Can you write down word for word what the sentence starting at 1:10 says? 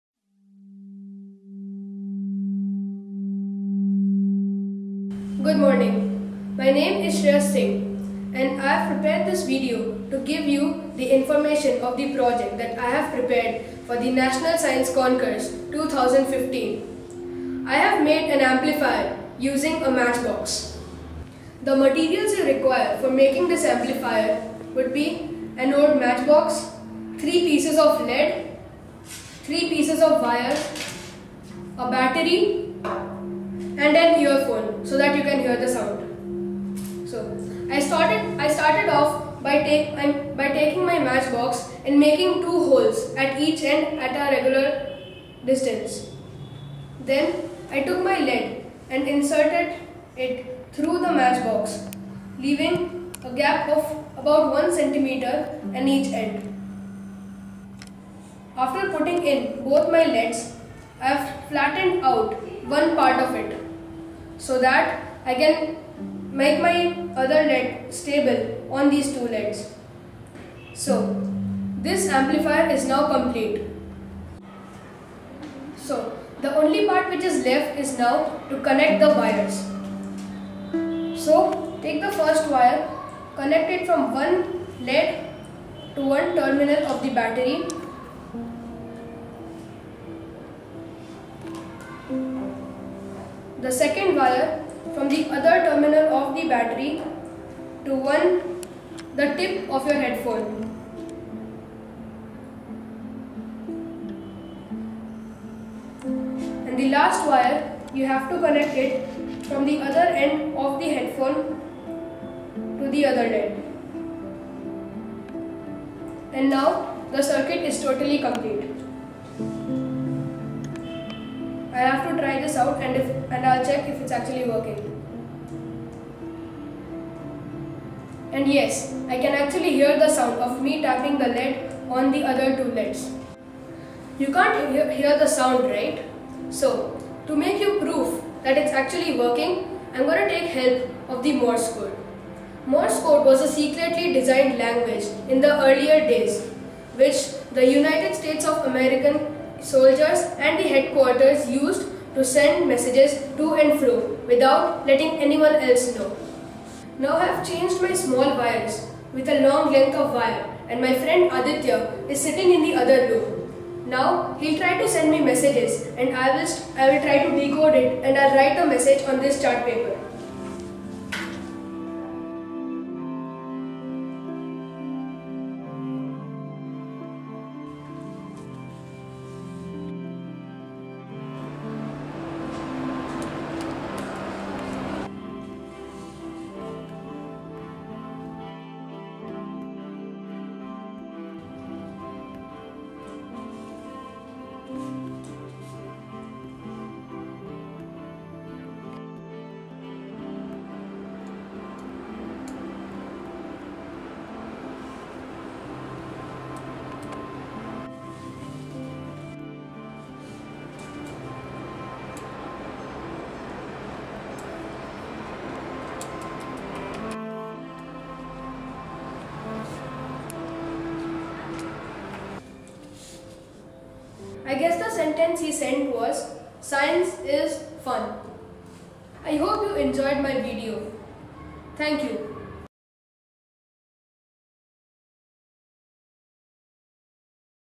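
So this amplifier is now complete.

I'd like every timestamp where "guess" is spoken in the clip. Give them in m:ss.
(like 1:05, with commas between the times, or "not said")
3:44.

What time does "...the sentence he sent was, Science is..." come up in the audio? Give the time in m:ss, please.
3:44.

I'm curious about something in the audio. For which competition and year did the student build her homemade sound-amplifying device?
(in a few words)
National Science Concourse 2015.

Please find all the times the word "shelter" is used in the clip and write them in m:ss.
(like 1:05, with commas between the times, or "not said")
not said.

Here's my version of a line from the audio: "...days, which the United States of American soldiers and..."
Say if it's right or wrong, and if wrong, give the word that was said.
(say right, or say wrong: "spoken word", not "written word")
right.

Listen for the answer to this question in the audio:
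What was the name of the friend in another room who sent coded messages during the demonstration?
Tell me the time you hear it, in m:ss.
2:41.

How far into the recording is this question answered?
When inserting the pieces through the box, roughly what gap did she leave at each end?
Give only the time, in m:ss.
0:54.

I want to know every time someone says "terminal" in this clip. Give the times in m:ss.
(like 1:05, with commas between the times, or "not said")
1:26, 1:35.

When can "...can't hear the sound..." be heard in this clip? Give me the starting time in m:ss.
2:14.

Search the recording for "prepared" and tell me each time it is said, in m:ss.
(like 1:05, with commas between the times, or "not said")
0:08, 0:13.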